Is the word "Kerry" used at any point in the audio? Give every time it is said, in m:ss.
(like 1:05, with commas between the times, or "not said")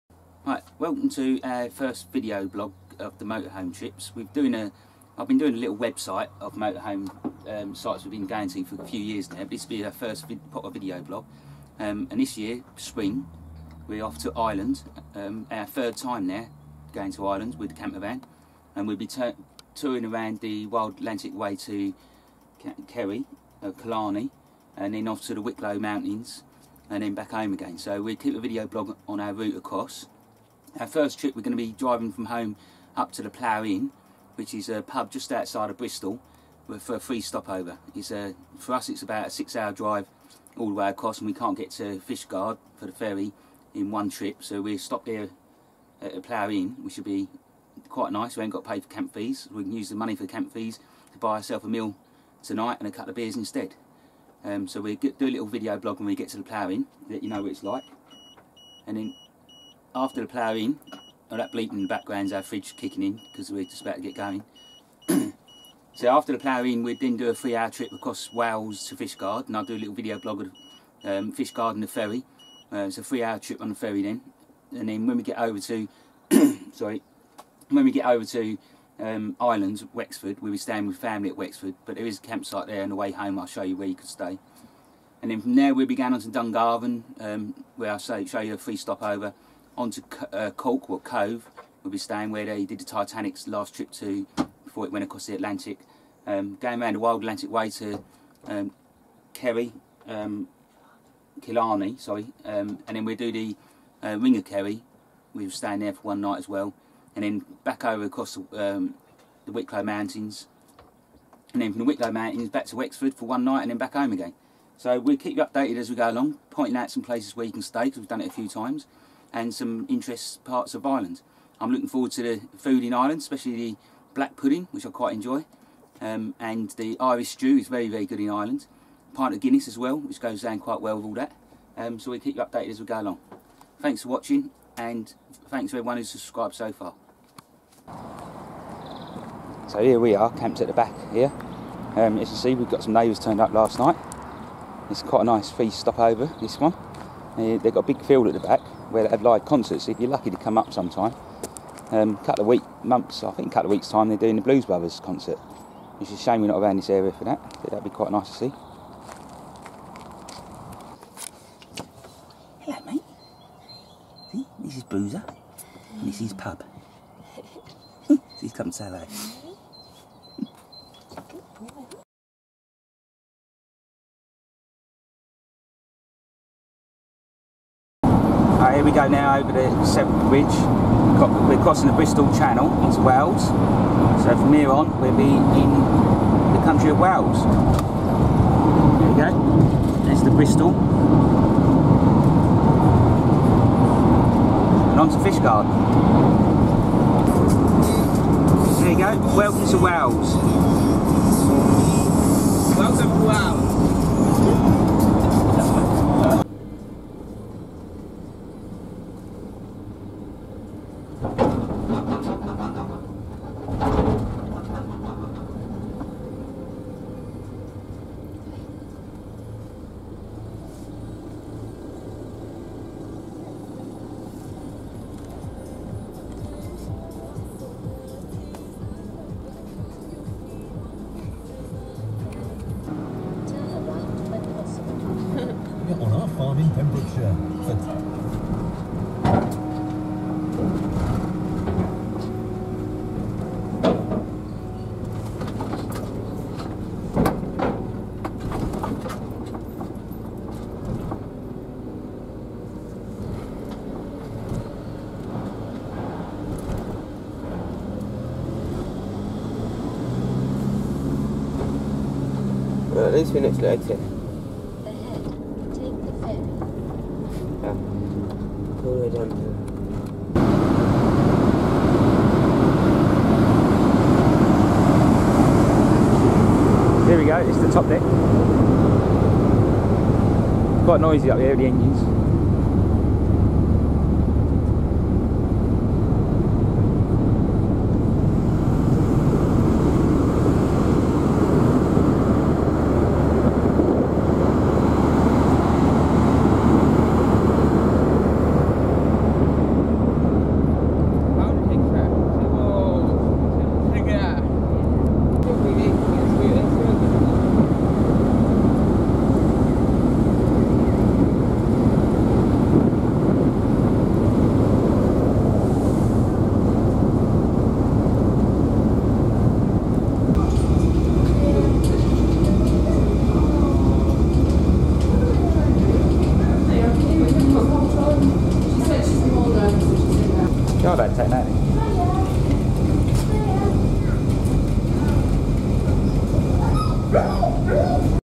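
0:22, 1:39, 1:44.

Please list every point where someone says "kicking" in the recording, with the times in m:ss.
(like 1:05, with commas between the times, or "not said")
1:02.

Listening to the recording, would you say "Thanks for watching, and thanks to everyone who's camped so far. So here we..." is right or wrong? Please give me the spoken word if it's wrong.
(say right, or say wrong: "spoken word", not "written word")
wrong: "subscribed", not "camped".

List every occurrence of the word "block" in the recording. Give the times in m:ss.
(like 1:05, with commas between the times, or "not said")
not said.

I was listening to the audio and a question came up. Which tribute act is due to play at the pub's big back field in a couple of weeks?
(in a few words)
Blues Brothers.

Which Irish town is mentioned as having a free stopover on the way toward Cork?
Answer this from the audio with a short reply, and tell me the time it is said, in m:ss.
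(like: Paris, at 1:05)
Dungarvan, at 1:26.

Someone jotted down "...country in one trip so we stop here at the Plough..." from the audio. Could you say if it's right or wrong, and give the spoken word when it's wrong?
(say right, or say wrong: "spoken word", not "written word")
wrong: "ferry", not "country".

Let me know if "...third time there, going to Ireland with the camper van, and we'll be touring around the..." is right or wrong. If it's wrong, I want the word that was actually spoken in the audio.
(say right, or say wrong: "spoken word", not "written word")
right.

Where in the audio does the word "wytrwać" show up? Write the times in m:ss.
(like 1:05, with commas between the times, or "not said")
3:57.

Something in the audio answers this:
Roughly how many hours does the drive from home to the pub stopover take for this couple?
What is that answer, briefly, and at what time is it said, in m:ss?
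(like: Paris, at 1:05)
6, at 0:39.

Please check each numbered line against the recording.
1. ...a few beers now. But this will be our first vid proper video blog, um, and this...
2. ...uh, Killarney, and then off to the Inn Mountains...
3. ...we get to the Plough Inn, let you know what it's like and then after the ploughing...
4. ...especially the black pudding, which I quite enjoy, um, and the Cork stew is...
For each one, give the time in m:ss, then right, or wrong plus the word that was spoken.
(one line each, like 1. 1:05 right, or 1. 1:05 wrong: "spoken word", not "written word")
1. 0:08 wrong: "years", not "beers"
2. 0:23 wrong: "Wicklow", not "Inn"
3. 0:56 right
4. 2:03 wrong: "Irish", not "Cork".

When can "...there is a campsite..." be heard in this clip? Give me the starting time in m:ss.
1:21.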